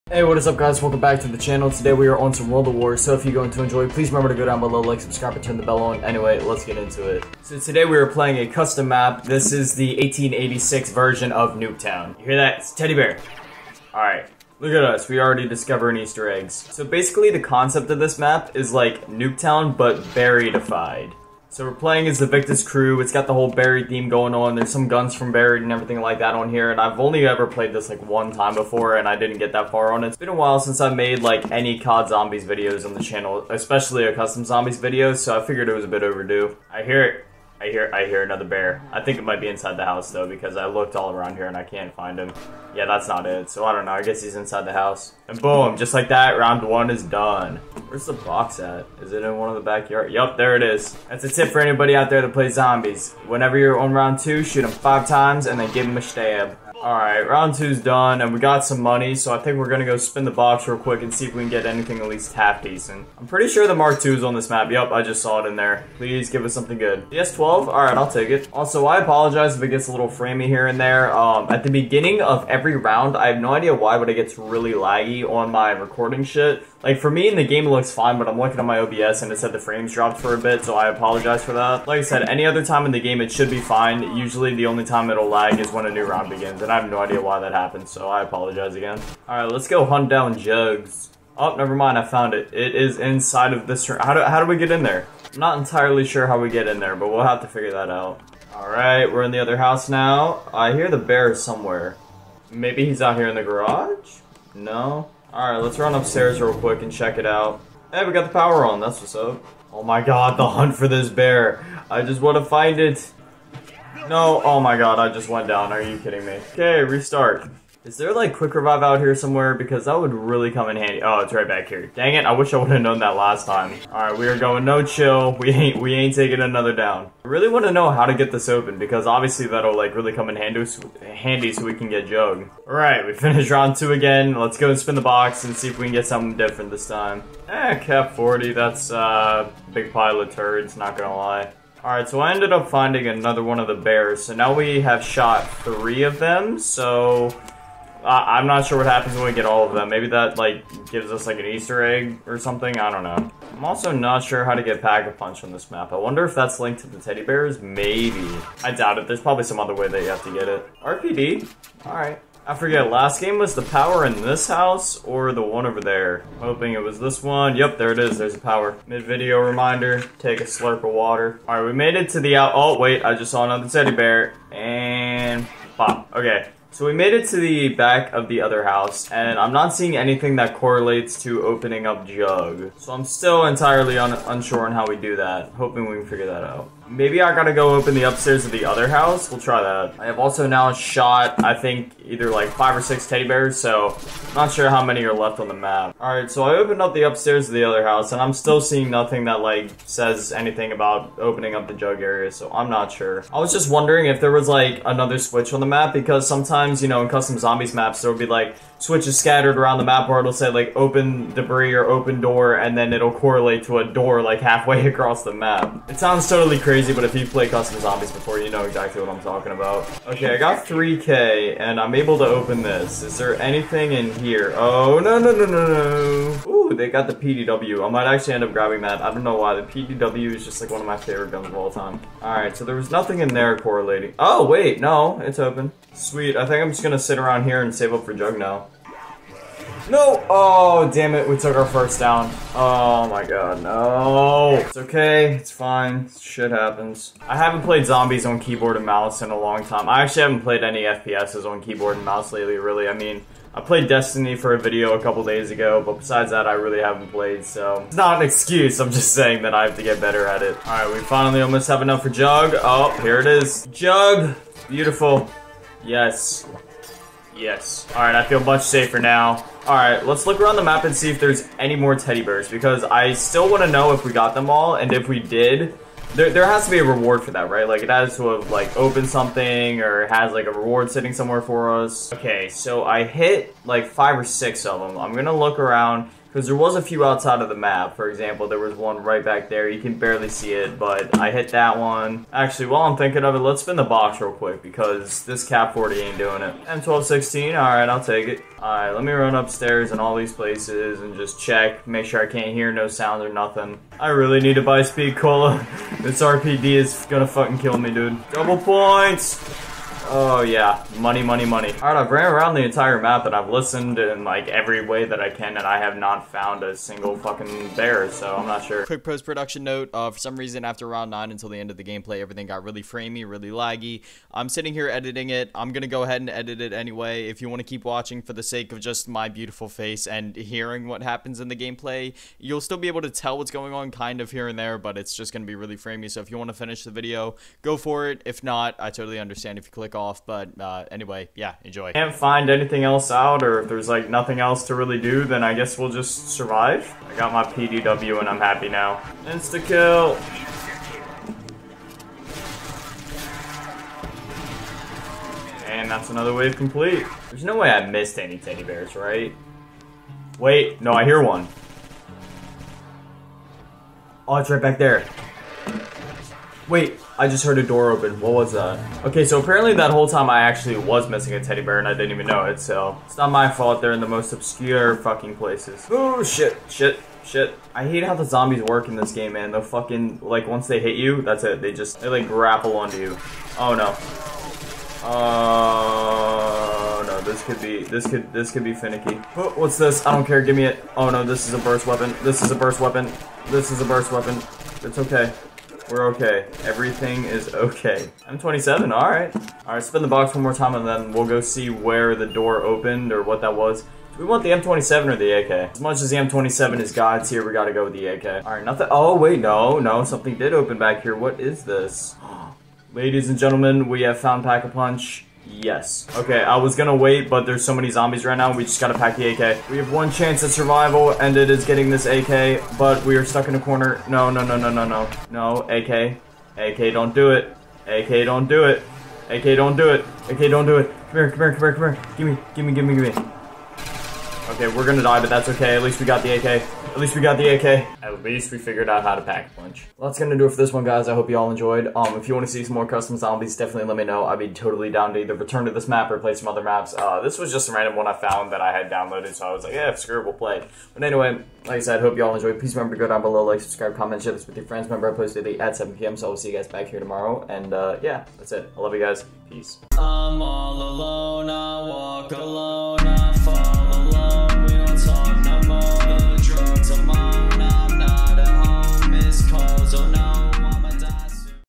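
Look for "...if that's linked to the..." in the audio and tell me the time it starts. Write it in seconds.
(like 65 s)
156 s.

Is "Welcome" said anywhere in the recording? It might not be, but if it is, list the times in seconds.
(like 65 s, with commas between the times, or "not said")
0 s.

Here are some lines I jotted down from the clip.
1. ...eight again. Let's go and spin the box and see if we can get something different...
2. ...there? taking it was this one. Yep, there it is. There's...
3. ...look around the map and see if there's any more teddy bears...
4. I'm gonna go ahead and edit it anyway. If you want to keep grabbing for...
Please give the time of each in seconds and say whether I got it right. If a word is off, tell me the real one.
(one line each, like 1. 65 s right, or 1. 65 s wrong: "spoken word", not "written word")
1. 133 s wrong: "two", not "eight"
2. 165 s wrong: "hoping", not "taking"
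3. 270 s right
4. 325 s wrong: "watching", not "grabbing".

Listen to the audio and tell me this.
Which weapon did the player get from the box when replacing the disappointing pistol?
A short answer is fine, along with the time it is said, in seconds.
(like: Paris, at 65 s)
M1216, at 296 s.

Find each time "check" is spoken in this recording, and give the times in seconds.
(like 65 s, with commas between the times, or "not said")
106 s, 301 s.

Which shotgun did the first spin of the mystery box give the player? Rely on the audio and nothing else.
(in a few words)
S12.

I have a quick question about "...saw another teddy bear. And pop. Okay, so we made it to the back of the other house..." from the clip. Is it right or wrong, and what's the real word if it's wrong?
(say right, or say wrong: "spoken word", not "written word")
right.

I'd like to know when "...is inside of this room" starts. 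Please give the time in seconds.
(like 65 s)
92 s.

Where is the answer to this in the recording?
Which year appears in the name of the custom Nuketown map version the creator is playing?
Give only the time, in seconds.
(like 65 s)
10 s.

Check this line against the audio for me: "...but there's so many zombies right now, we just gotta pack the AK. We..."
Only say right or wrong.
right.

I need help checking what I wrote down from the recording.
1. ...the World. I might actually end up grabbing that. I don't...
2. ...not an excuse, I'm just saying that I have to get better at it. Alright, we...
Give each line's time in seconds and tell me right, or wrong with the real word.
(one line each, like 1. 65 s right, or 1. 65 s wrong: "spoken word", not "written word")
1. 227 s wrong: "PDW", not "World"
2. 257 s right.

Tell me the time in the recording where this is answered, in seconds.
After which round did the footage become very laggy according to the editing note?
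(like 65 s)
320 s.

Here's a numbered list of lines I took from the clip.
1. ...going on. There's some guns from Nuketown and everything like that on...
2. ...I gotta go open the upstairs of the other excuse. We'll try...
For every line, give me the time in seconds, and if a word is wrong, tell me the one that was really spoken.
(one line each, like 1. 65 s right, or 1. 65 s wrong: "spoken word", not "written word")
1. 24 s wrong: "Buried", not "Nuketown"
2. 187 s wrong: "house", not "excuse".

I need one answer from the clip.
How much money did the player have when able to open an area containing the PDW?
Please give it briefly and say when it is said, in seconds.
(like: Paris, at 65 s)
3k, at 220 s.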